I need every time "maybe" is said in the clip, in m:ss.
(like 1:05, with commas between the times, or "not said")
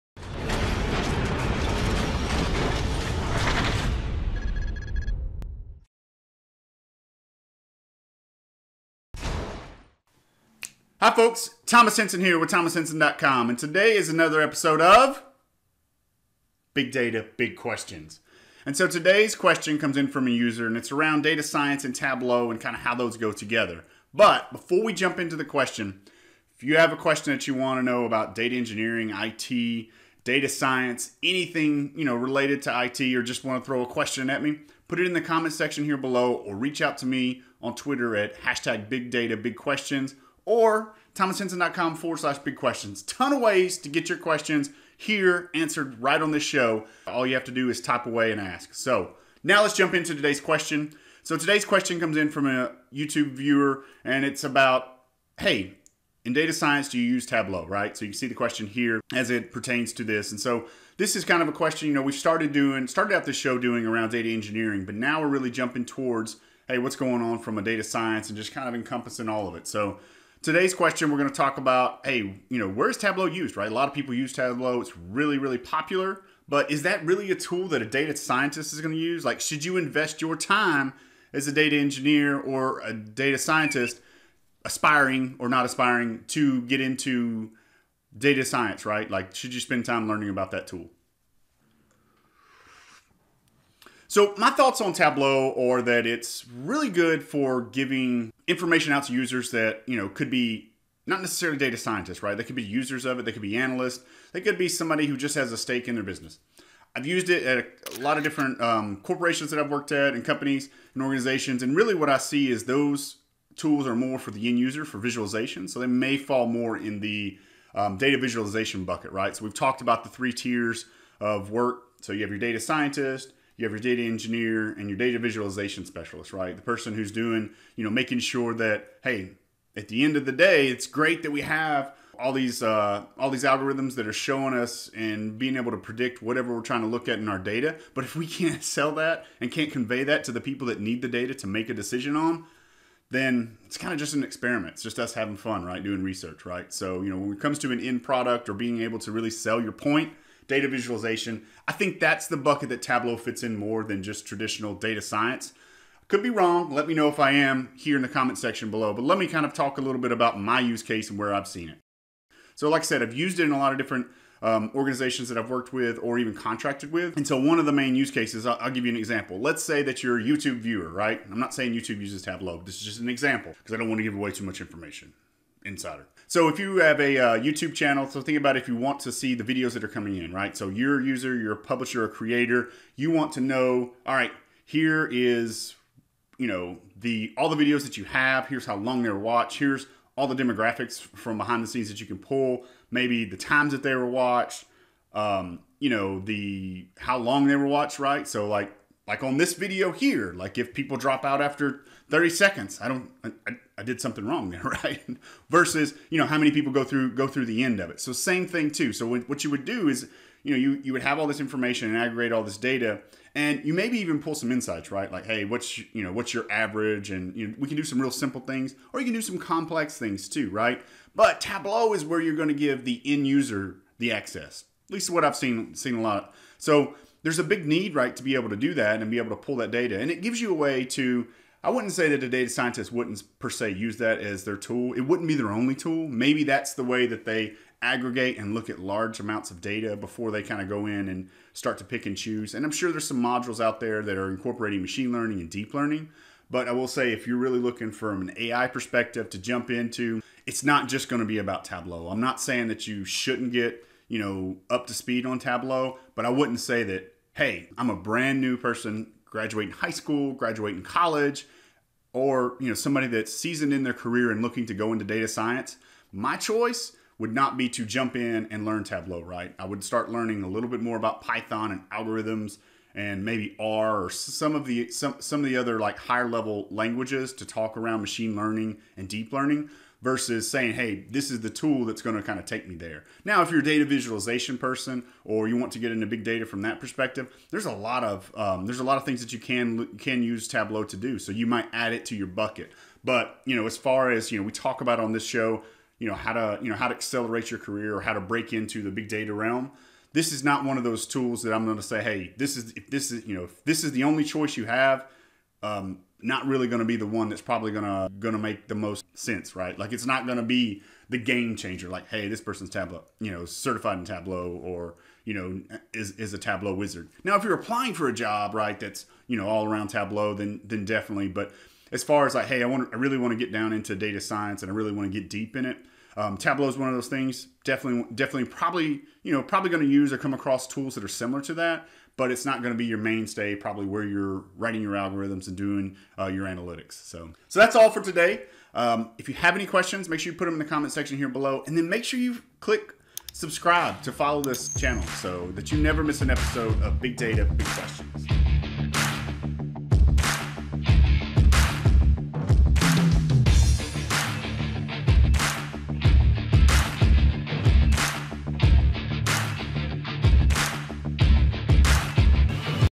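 3:12, 3:33, 3:56, 4:33.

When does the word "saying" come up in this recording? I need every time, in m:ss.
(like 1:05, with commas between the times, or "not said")
2:51, 4:12, 4:40.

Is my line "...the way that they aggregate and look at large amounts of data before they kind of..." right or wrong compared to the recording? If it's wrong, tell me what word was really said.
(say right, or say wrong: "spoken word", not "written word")
right.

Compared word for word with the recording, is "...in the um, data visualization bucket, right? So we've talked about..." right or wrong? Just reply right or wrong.
right.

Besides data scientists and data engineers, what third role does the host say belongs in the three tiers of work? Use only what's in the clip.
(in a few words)
data visualization specialist.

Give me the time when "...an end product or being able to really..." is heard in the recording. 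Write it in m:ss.
2:27.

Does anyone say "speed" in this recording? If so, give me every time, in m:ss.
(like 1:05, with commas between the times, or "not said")
4:14.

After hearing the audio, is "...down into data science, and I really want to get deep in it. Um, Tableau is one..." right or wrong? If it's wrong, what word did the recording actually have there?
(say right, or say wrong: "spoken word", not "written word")
right.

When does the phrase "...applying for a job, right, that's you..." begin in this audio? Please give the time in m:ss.
5:17.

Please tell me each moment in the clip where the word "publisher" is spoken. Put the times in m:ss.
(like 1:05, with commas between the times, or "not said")
3:01.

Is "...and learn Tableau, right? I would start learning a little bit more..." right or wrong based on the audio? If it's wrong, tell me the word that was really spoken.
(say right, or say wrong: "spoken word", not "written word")
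right.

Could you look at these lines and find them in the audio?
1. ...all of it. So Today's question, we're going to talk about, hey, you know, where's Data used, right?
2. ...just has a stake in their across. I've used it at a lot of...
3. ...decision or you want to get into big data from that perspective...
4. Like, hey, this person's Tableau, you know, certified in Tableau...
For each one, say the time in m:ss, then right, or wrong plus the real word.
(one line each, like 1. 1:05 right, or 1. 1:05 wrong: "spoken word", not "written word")
1. 1:09 wrong: "Tableau", not "Data"
2. 1:45 wrong: "business", not "across"
3. 4:44 wrong: "person", not "decision"
4. 5:11 right.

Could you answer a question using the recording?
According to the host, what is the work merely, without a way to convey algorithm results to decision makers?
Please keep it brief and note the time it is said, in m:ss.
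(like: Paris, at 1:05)
an experiment, at 2:24.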